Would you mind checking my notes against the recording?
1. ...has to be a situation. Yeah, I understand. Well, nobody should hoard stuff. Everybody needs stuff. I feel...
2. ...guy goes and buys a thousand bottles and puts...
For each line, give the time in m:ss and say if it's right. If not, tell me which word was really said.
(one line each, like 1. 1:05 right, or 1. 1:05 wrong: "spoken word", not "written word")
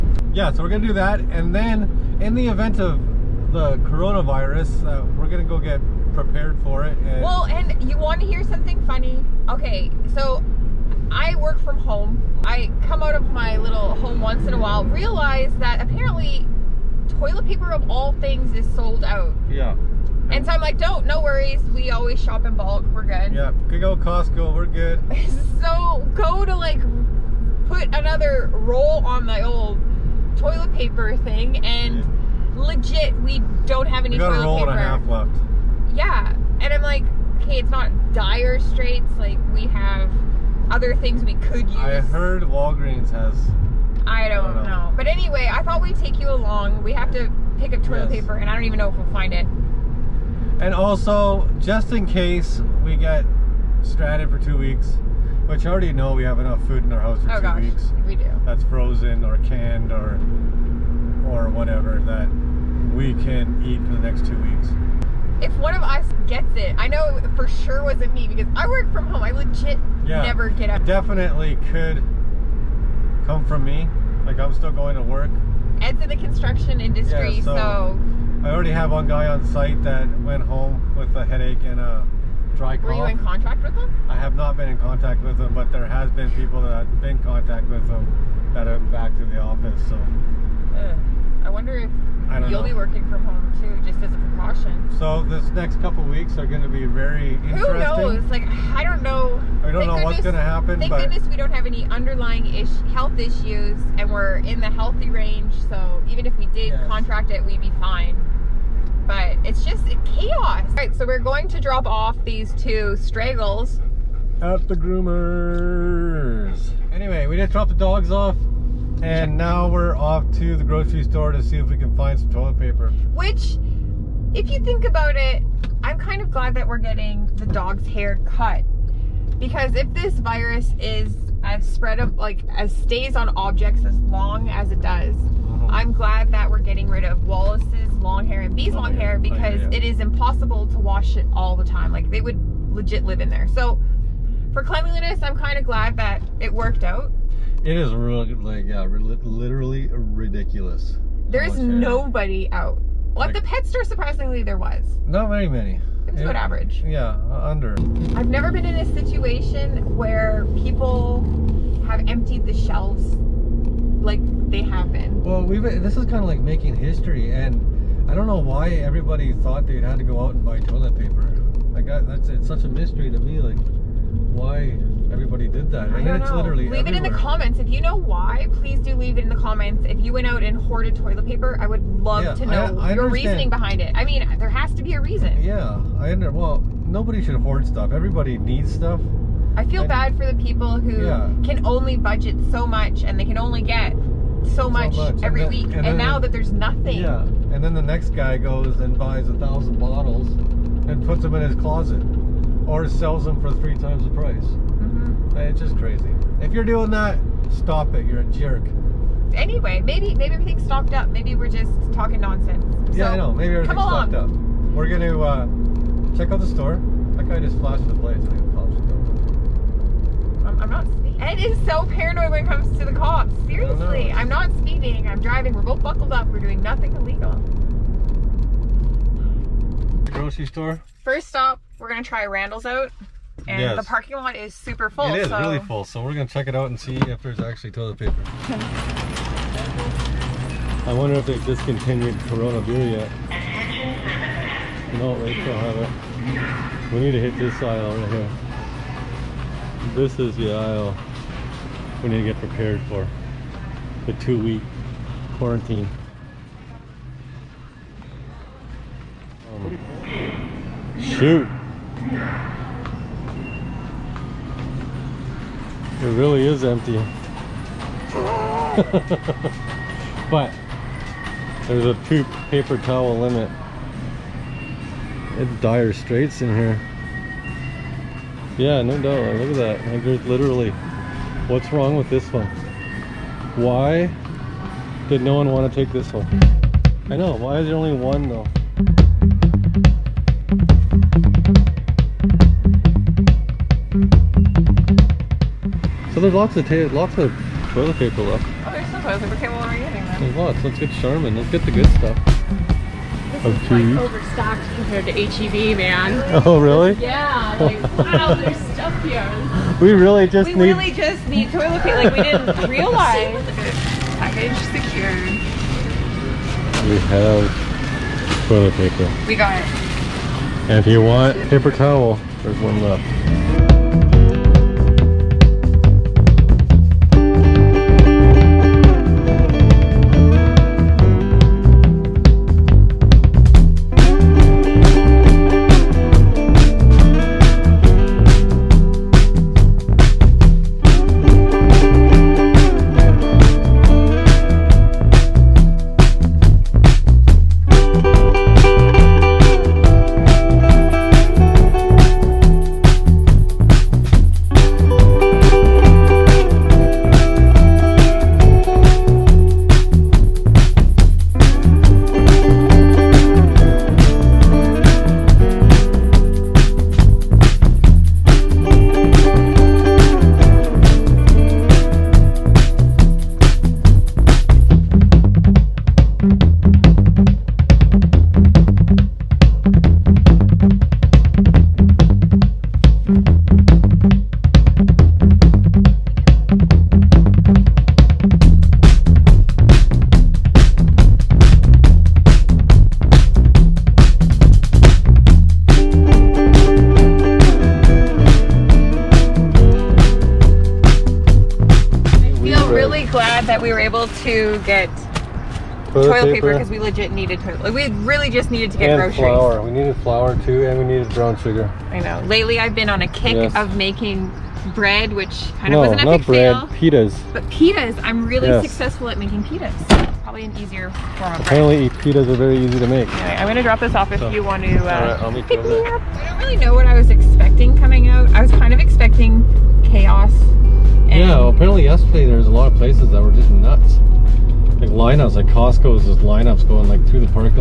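1. 3:04 wrong: "reason", not "situation"
2. 3:18 right.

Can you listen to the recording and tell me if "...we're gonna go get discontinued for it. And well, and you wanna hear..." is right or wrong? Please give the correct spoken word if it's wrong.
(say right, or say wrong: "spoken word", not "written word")
wrong: "prepared", not "discontinued".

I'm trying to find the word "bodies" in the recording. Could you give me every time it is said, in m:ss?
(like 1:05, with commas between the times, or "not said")
not said.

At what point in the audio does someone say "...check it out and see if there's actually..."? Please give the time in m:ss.
3:56.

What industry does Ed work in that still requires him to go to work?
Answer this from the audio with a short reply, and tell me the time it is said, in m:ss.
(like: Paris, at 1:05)
Construction, at 1:16.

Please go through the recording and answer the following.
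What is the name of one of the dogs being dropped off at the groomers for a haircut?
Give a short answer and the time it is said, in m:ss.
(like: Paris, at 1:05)
Wallace, at 2:17.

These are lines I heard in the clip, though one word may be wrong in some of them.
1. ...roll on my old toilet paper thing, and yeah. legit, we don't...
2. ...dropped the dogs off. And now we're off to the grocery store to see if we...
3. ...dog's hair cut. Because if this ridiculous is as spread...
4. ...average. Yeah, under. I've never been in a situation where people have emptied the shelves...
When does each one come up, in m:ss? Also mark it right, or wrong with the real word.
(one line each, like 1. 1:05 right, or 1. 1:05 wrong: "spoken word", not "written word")
1. 0:28 right
2. 1:57 right
3. 2:07 wrong: "virus", not "ridiculous"
4. 2:36 right.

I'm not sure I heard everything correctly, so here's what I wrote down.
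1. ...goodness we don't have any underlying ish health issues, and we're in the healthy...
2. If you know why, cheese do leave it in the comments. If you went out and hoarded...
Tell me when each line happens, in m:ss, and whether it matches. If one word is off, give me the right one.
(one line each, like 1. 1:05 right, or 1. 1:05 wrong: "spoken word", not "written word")
1. 1:40 right
2. 2:57 wrong: "please", not "cheese".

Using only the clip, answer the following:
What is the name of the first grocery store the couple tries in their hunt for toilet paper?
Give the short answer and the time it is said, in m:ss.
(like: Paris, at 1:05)
Randall's, at 3:52.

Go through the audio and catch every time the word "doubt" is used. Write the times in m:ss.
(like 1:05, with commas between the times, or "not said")
4:38.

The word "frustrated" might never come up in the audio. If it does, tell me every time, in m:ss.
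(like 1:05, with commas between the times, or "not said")
not said.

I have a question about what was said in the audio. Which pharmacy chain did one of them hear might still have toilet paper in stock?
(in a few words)
Walgreens.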